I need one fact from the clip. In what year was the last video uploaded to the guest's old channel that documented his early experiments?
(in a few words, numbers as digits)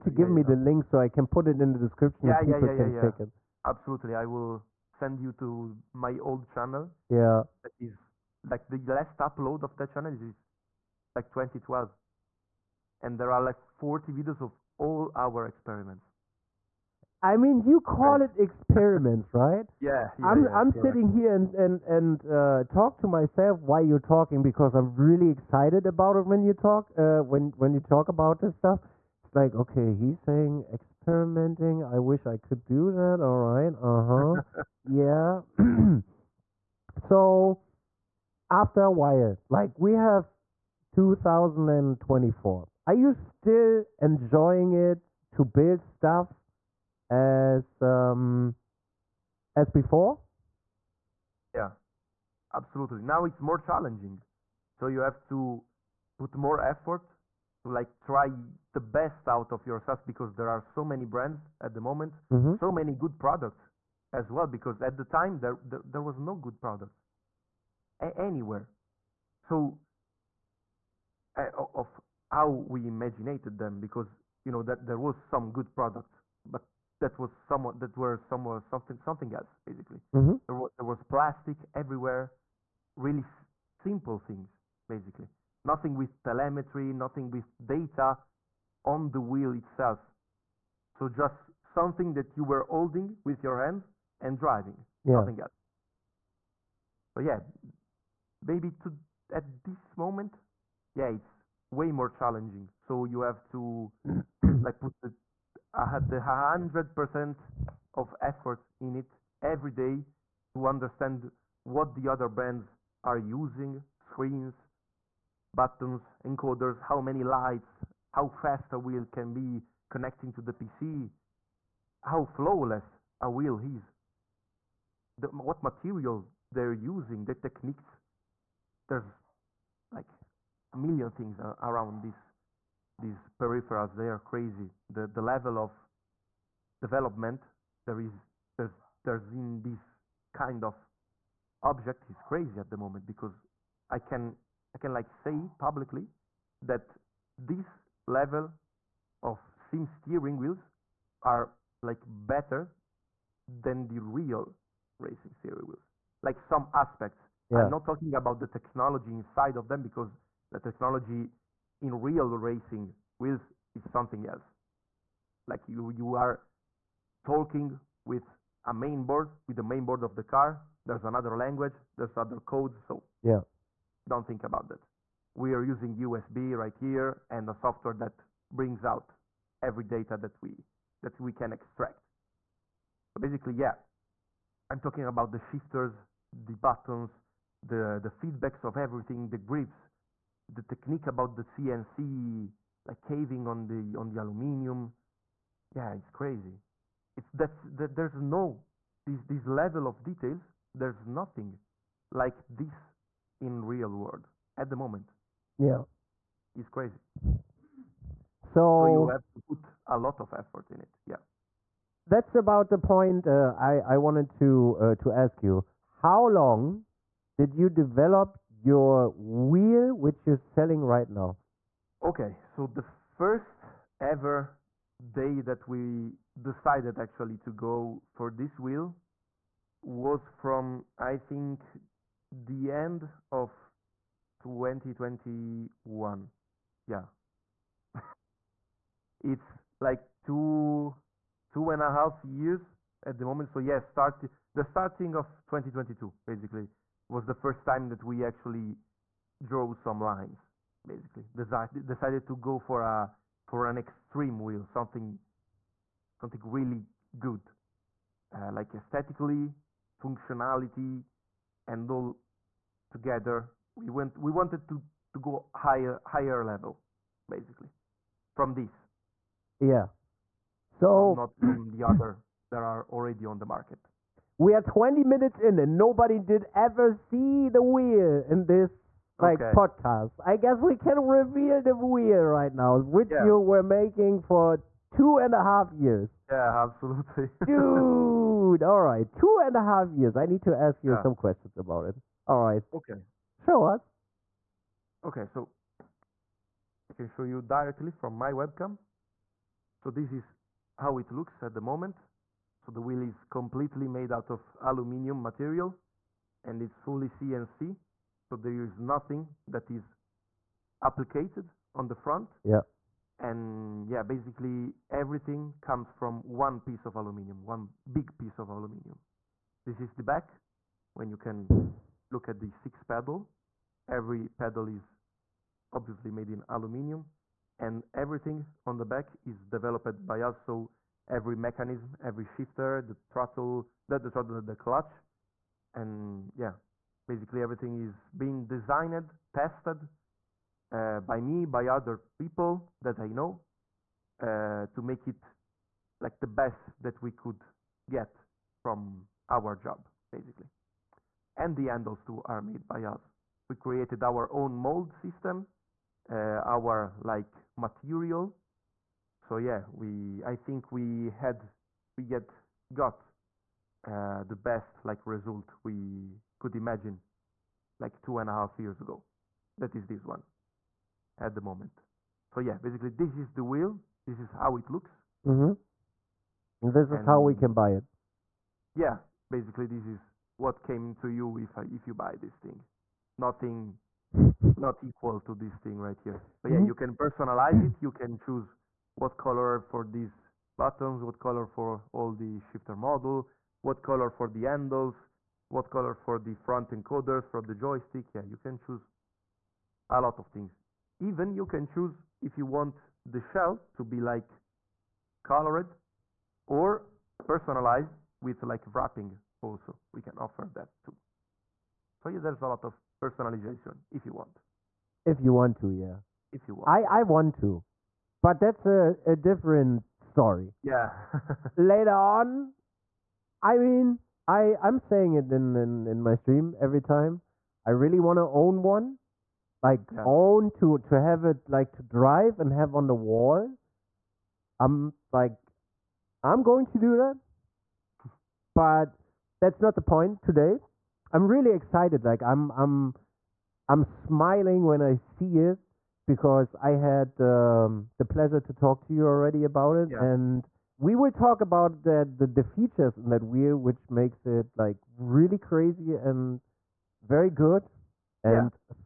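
2012.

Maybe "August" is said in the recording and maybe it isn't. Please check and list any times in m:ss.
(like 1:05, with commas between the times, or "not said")
not said.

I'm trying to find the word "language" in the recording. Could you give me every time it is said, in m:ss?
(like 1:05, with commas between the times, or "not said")
2:51.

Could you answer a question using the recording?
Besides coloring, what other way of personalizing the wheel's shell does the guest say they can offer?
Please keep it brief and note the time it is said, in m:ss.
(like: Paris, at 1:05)
Wrapping, at 6:48.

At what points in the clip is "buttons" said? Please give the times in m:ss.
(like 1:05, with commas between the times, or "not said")
1:55, 3:06, 6:30.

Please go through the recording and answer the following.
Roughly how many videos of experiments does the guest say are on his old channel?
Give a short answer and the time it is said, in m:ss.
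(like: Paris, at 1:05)
40, at 0:13.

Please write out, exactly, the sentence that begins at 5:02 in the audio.
So the wheel is completely made out of aluminium material and it's fully CNC.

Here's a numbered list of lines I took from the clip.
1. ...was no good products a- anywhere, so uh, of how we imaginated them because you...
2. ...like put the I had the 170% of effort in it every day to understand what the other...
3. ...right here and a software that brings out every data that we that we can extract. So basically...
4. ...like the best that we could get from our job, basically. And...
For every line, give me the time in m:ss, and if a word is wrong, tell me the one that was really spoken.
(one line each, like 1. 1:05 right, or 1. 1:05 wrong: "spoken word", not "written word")
1. 1:06 right
2. 1:44 wrong: "100", not "170"
3. 2:56 right
4. 5:46 right.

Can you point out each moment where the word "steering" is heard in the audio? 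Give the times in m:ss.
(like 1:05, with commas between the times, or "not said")
2:29, 2:35.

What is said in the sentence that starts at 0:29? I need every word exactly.
It's like okay, he's saying experimenting.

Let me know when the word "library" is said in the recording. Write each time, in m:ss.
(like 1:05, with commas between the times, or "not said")
not said.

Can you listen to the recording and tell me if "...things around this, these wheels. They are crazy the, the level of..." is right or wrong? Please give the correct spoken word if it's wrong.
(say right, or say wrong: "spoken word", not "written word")
wrong: "peripherals", not "wheels".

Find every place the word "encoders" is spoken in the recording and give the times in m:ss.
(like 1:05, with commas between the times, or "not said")
1:56, 6:36.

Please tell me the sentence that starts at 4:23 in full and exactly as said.
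We went we wanted to to go higher higher level, basically, from this.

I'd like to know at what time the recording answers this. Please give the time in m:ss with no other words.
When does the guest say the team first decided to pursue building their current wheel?
3:52.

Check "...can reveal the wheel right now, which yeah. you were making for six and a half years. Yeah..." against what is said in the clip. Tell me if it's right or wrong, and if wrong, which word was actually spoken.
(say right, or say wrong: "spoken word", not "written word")
wrong: "two", not "six".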